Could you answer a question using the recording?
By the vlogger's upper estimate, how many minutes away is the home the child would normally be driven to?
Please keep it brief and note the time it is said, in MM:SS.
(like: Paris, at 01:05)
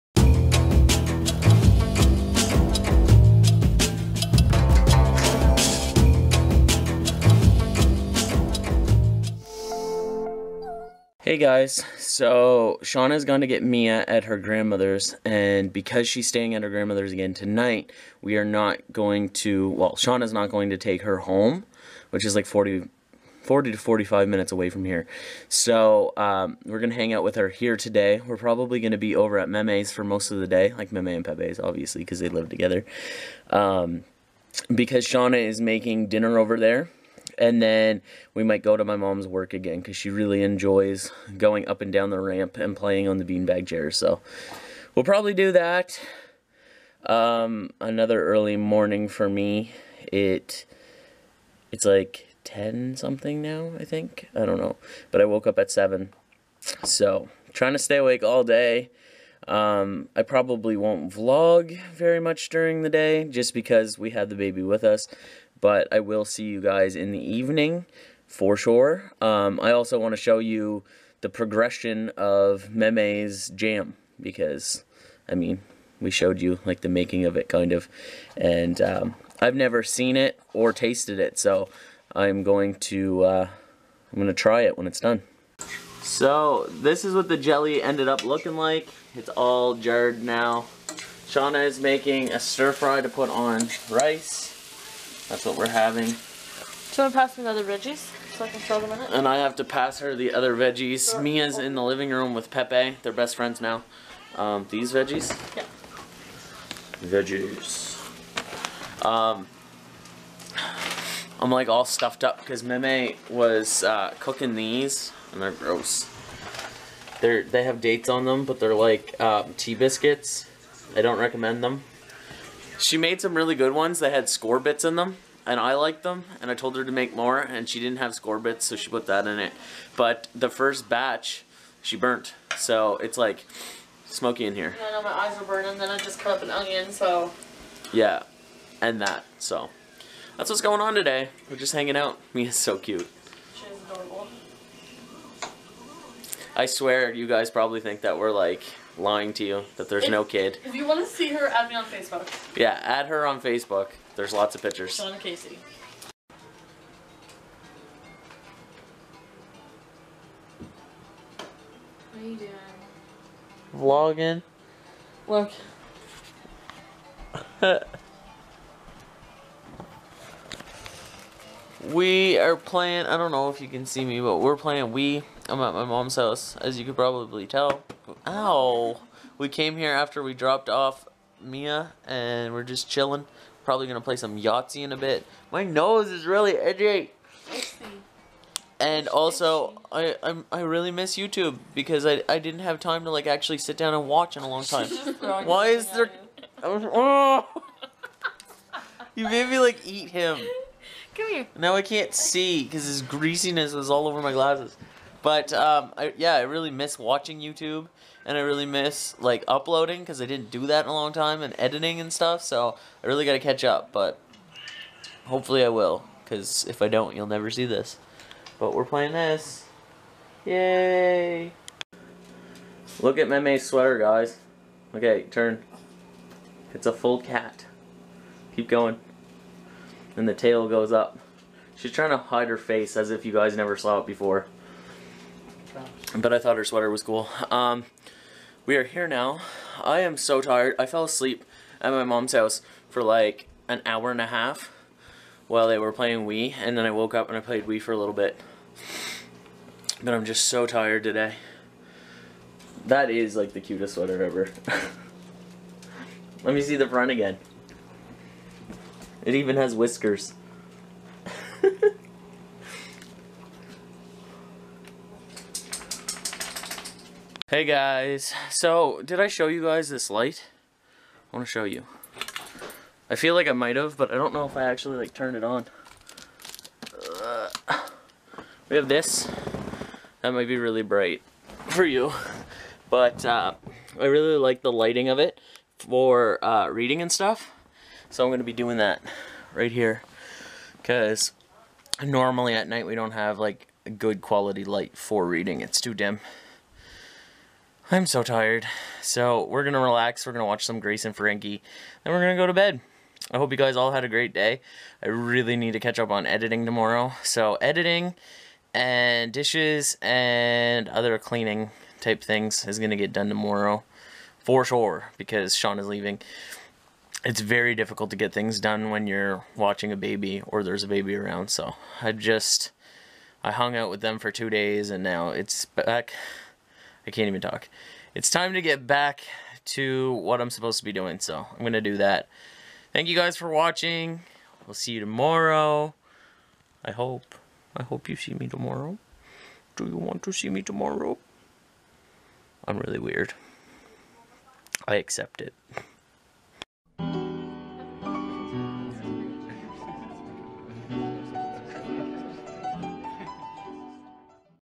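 45 minutes, at 00:23.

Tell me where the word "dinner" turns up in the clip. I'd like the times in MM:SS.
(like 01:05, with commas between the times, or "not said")
00:36.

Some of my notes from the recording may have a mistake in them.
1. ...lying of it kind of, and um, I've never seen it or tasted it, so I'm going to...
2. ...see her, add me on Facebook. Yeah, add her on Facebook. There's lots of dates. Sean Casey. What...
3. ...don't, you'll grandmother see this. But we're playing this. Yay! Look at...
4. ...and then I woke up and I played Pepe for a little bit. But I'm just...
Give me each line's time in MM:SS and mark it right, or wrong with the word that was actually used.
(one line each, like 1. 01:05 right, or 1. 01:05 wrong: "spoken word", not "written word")
1. 01:16 wrong: "making", not "lying"
2. 02:31 wrong: "pictures", not "dates"
3. 03:36 wrong: "never", not "grandmother"
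4. 04:06 wrong: "Wii", not "Pepe".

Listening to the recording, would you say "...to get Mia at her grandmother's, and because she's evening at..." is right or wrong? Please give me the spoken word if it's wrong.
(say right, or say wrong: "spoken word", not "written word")
wrong: "staying", not "evening".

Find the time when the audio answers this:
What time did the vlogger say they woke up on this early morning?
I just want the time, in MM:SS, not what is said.
00:55.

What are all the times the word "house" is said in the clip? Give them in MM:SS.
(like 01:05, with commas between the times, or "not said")
02:56, 04:02.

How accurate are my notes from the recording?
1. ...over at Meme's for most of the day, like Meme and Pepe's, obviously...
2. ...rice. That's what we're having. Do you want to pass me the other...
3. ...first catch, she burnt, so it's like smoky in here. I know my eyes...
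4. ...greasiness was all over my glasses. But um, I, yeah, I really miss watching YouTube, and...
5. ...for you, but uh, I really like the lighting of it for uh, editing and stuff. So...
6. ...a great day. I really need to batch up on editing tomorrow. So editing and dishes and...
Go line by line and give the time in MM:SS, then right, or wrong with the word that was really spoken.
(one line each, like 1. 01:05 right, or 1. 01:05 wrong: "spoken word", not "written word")
1. 00:29 right
2. 01:33 right
3. 02:10 wrong: "batch", not "catch"
4. 03:23 right
5. 04:41 wrong: "reading", not "editing"
6. 05:04 wrong: "catch", not "batch".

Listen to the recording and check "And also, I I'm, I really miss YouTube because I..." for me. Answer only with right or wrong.
right.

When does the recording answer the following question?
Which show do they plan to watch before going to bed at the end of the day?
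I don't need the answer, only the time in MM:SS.
05:00.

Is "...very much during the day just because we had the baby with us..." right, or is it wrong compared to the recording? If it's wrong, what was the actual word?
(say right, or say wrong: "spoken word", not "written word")
right.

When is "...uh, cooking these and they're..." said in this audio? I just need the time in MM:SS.
01:53.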